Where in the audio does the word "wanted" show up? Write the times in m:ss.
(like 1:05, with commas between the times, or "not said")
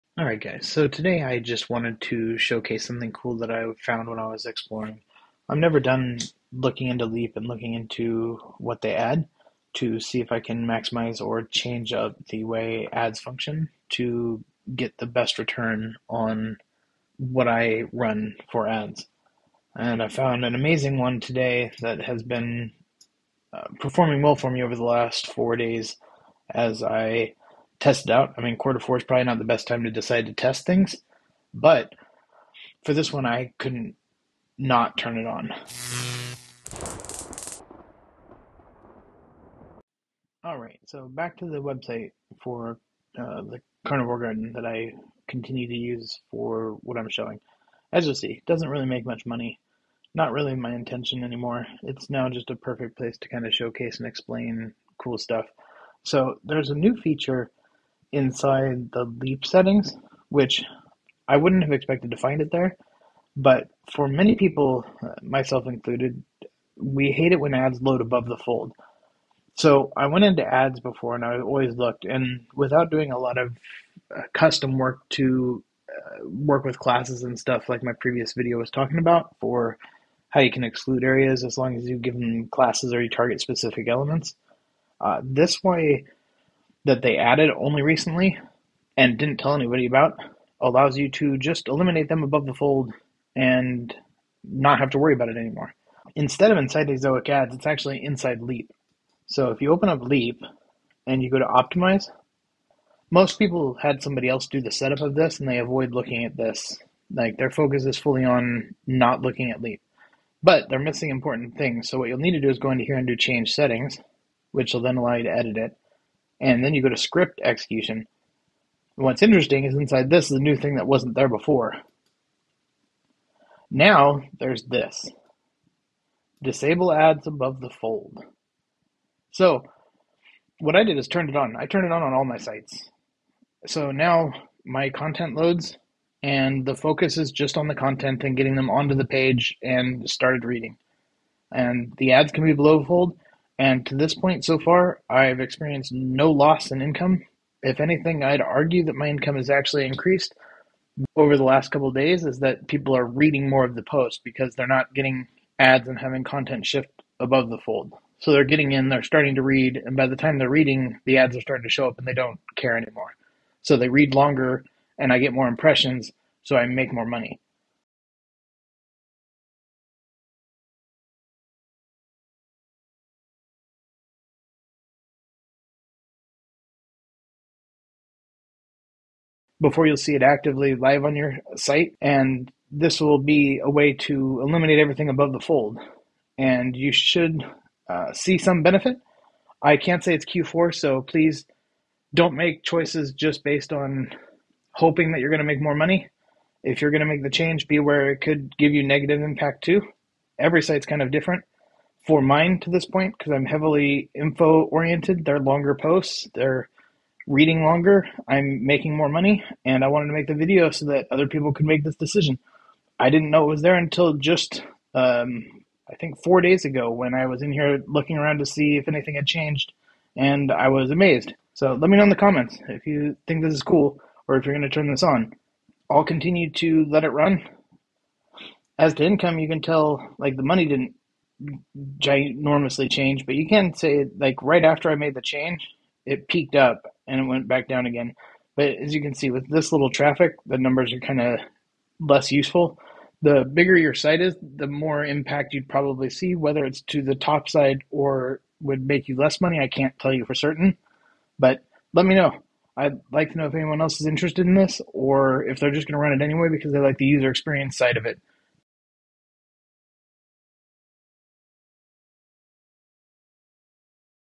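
0:01, 3:29.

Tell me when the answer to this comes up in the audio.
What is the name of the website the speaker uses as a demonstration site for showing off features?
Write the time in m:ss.
0:43.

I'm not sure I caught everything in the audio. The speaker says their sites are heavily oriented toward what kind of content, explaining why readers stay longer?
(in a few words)
Info.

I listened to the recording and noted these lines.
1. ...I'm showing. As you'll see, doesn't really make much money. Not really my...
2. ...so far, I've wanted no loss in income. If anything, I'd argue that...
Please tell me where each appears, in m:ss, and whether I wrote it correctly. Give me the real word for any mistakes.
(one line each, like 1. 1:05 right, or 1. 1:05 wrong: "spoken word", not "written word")
1. 0:46 right
2. 2:24 wrong: "experienced", not "wanted".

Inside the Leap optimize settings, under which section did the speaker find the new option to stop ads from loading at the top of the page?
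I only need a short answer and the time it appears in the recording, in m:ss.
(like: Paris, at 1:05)
Script execution, at 1:56.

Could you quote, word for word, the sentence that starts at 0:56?
So there's a new feature inside the leap settings, which I wouldn't have expected to find it there.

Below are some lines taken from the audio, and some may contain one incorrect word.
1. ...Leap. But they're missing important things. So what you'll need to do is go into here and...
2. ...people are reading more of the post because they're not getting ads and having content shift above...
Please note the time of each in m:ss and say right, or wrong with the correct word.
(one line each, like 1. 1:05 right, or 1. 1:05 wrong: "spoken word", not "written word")
1. 1:49 right
2. 2:32 right.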